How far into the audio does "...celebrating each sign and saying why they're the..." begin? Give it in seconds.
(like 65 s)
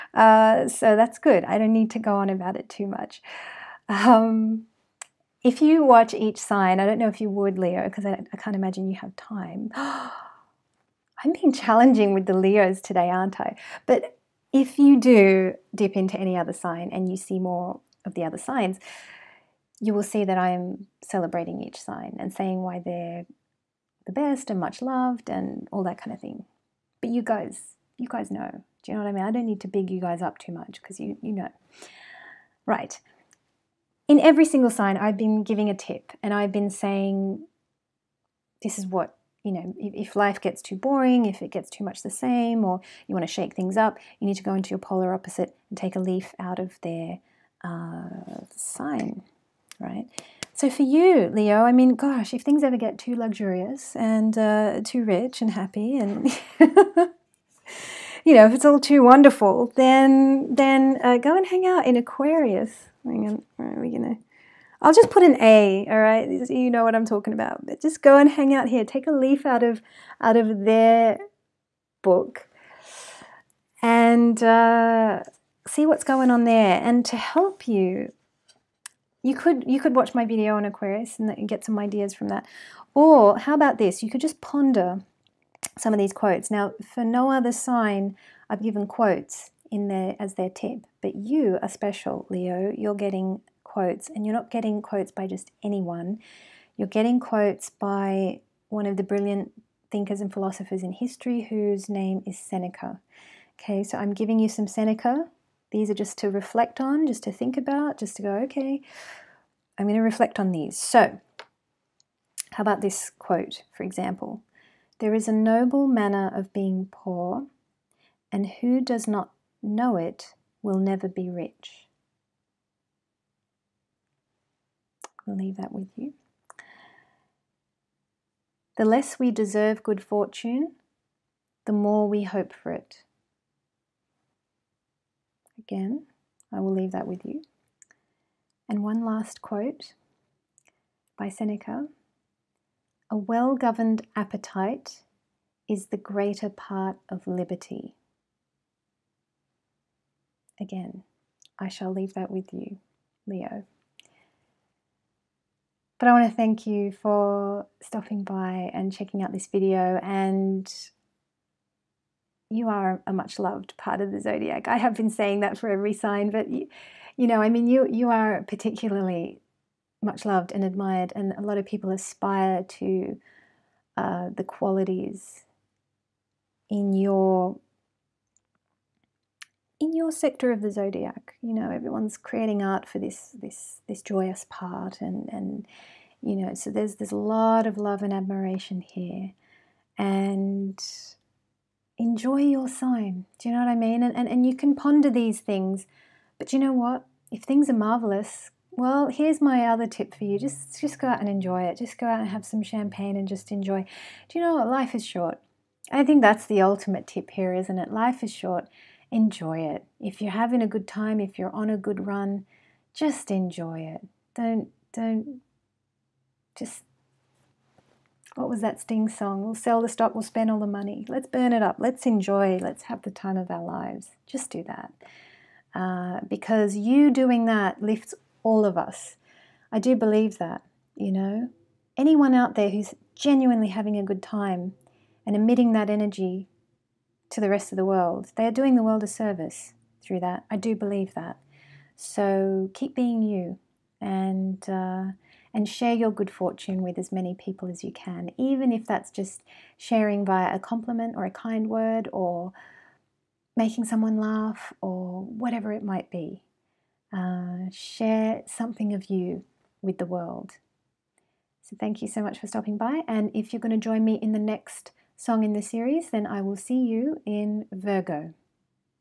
21 s.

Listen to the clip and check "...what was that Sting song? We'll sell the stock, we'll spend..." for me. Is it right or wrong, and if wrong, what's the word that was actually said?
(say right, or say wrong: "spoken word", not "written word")
right.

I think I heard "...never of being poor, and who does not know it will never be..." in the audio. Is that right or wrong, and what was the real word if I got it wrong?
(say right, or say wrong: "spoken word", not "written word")
wrong: "manner", not "never".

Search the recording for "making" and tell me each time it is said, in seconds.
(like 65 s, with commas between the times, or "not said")
253 s.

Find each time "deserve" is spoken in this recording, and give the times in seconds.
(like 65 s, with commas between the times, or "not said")
129 s.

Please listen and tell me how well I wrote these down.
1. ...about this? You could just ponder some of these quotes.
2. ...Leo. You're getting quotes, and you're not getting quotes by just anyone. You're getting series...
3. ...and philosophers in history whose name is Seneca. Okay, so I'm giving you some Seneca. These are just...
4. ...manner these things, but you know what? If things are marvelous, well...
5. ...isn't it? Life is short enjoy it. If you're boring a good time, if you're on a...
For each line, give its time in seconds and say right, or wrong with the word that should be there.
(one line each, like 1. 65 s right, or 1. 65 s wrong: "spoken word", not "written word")
1. 83 s right
2. 92 s wrong: "quotes", not "series"
3. 100 s right
4. 194 s wrong: "ponder", not "manner"
5. 207 s wrong: "having", not "boring".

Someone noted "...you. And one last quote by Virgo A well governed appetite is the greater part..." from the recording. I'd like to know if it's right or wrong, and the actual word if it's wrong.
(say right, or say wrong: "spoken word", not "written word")
wrong: "Seneca", not "Virgo".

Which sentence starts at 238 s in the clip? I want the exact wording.
They are doing the world a service through that.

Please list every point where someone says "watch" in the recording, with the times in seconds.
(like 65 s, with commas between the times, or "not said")
5 s, 79 s.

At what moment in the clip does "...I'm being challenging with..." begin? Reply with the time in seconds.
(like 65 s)
11 s.